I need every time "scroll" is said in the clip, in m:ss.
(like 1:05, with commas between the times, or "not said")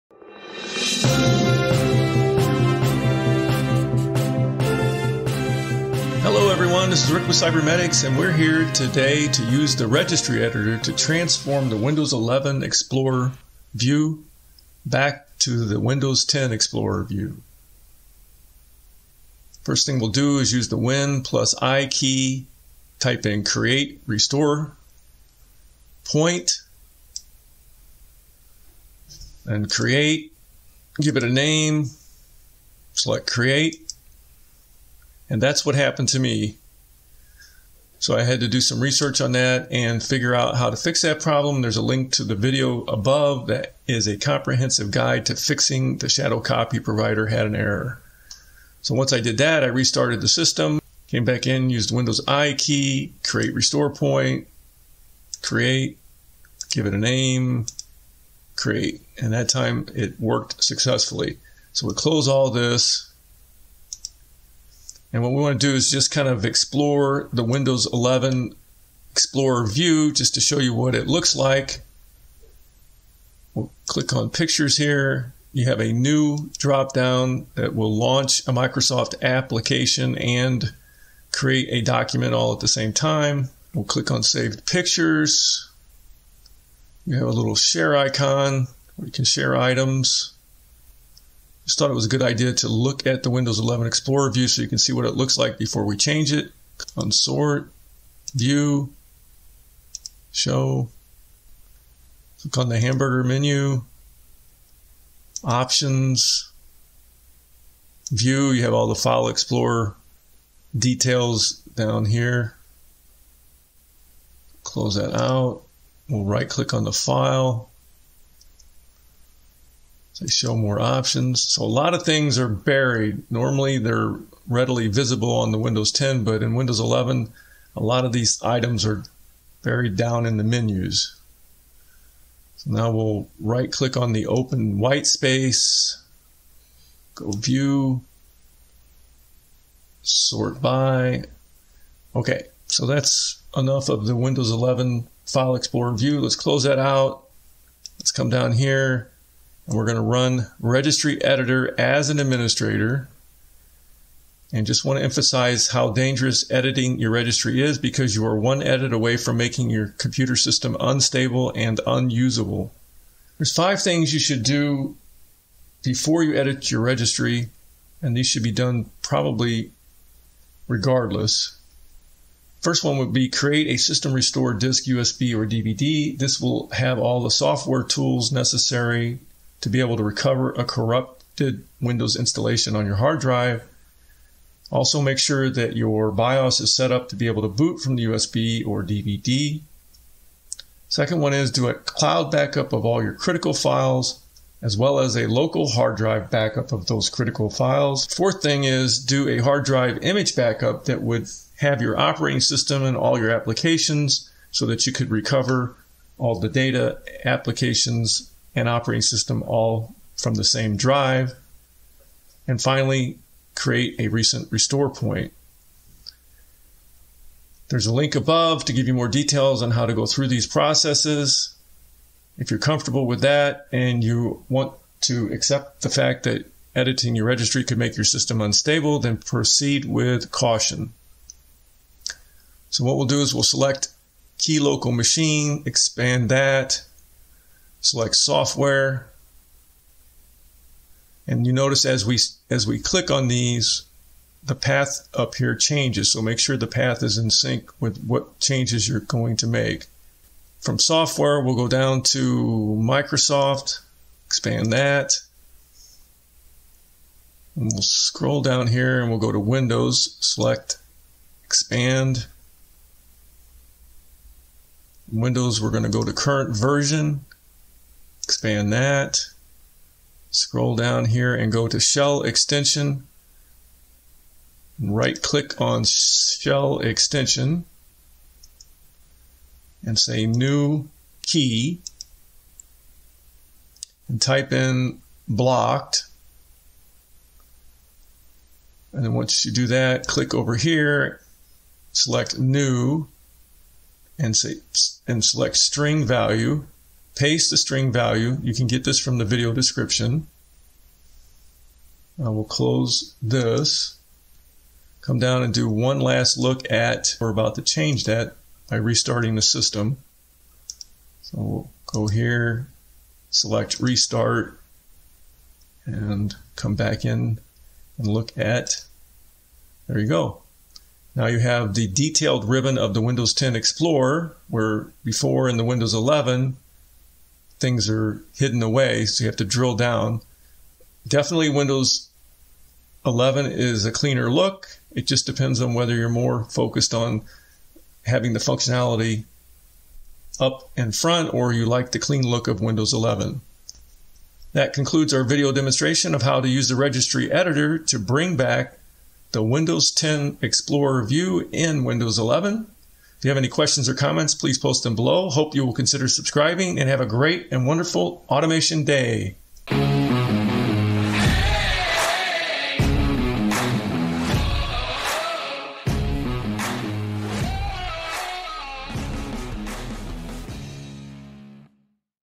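4:17, 4:30.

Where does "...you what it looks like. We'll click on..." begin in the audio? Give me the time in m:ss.
1:10.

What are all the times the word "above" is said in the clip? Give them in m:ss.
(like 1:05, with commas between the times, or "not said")
0:42, 3:38.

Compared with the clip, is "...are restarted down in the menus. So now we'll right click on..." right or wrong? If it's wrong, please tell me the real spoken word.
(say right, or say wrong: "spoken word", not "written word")
wrong: "buried", not "restarted".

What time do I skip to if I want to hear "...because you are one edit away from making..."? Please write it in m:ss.
2:37.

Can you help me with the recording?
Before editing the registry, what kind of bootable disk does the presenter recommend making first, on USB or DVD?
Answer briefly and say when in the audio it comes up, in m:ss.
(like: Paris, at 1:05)
system restore disk, at 2:53.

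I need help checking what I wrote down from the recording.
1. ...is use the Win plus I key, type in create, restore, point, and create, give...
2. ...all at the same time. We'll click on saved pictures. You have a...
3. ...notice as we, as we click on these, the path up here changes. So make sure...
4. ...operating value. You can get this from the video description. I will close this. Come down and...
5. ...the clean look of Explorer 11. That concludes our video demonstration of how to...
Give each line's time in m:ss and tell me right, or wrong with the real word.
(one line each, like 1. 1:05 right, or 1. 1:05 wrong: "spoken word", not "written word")
1. 0:20 right
2. 1:22 right
3. 4:01 right
4. 4:57 wrong: "string", not "operating"
5. 5:41 wrong: "Windows", not "Explorer".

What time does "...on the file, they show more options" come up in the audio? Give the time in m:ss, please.
1:56.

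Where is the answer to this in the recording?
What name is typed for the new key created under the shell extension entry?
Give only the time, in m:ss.
4:45.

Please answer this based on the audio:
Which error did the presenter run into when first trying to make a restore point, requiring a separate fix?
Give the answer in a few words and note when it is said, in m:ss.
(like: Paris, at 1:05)
shadow copy provider had an error, at 0:46.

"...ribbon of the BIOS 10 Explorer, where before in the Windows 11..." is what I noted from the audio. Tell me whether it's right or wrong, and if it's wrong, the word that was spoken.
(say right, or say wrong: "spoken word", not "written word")
wrong: "Windows", not "BIOS".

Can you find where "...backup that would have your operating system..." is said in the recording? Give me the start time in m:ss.
3:20.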